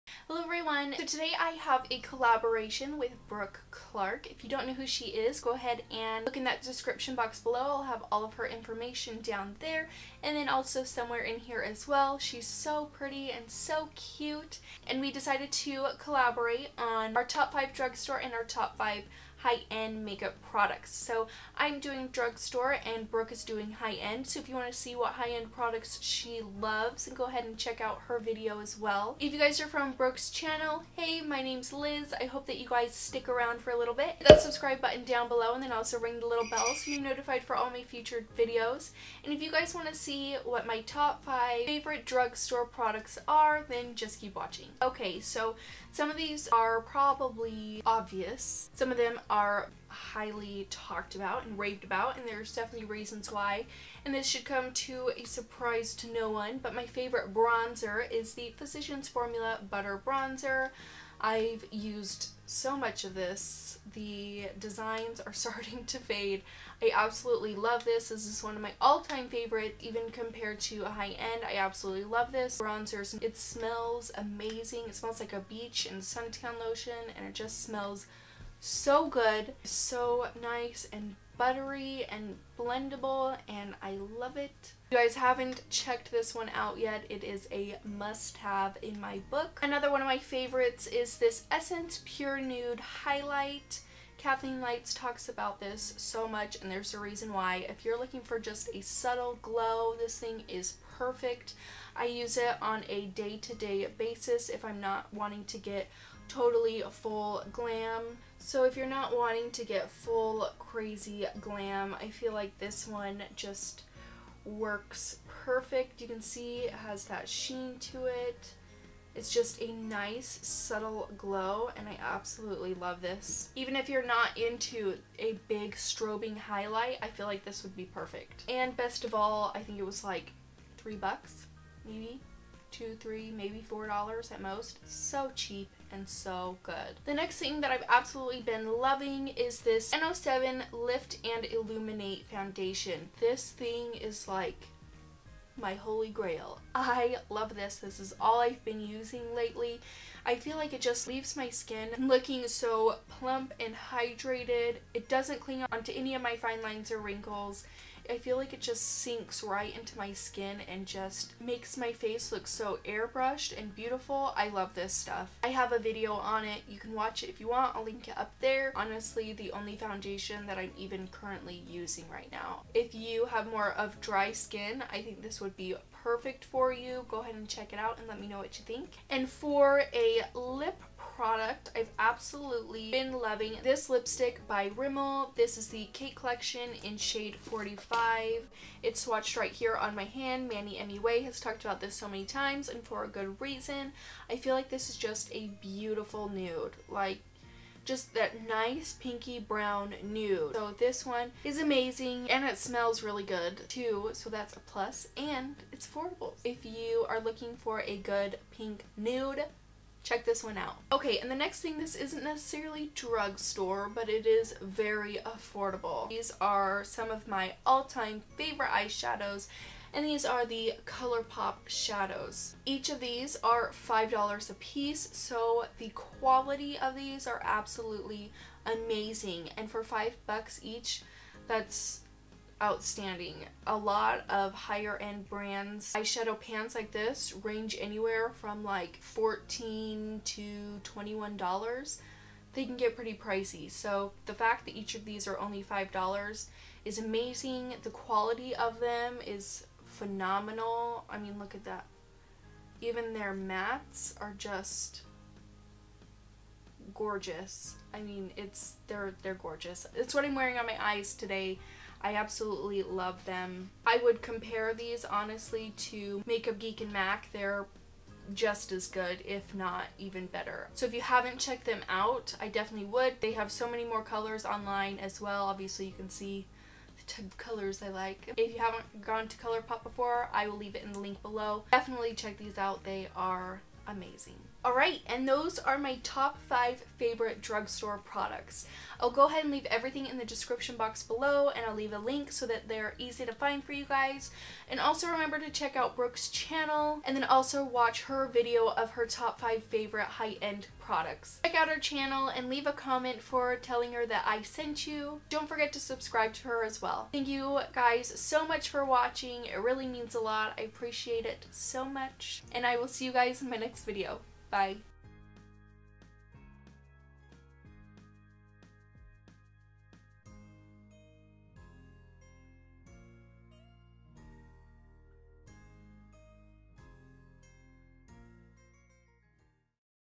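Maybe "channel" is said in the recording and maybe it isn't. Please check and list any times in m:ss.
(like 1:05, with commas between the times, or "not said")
0:30, 4:56, 5:01.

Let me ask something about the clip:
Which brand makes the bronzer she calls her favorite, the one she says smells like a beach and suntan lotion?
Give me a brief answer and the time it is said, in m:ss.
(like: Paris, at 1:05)
Physicians Formula, at 0:58.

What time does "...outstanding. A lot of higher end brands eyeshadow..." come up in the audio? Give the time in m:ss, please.
3:52.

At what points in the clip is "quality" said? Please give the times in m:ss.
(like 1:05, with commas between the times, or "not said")
3:45, 4:07.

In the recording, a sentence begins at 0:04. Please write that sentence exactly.
If you don't know who she is, go ahead and look in that description box below.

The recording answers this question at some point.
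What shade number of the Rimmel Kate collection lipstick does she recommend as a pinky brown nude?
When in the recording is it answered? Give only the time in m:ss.
3:07.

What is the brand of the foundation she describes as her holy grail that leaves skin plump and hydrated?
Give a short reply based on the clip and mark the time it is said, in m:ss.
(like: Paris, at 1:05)
No7, at 2:19.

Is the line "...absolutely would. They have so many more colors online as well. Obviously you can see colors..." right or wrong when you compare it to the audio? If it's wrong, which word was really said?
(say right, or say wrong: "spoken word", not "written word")
wrong: "definitely", not "absolutely".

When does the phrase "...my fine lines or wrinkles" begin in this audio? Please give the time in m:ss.
2:36.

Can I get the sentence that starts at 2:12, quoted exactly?
two, three, maybe four dollars at most.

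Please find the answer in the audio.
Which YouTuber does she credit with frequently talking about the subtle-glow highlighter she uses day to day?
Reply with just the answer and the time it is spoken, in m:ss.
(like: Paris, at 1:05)
Kathleen Lights, at 1:34.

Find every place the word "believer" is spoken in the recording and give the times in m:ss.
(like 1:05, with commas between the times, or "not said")
not said.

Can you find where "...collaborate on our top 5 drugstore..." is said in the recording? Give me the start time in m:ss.
0:15.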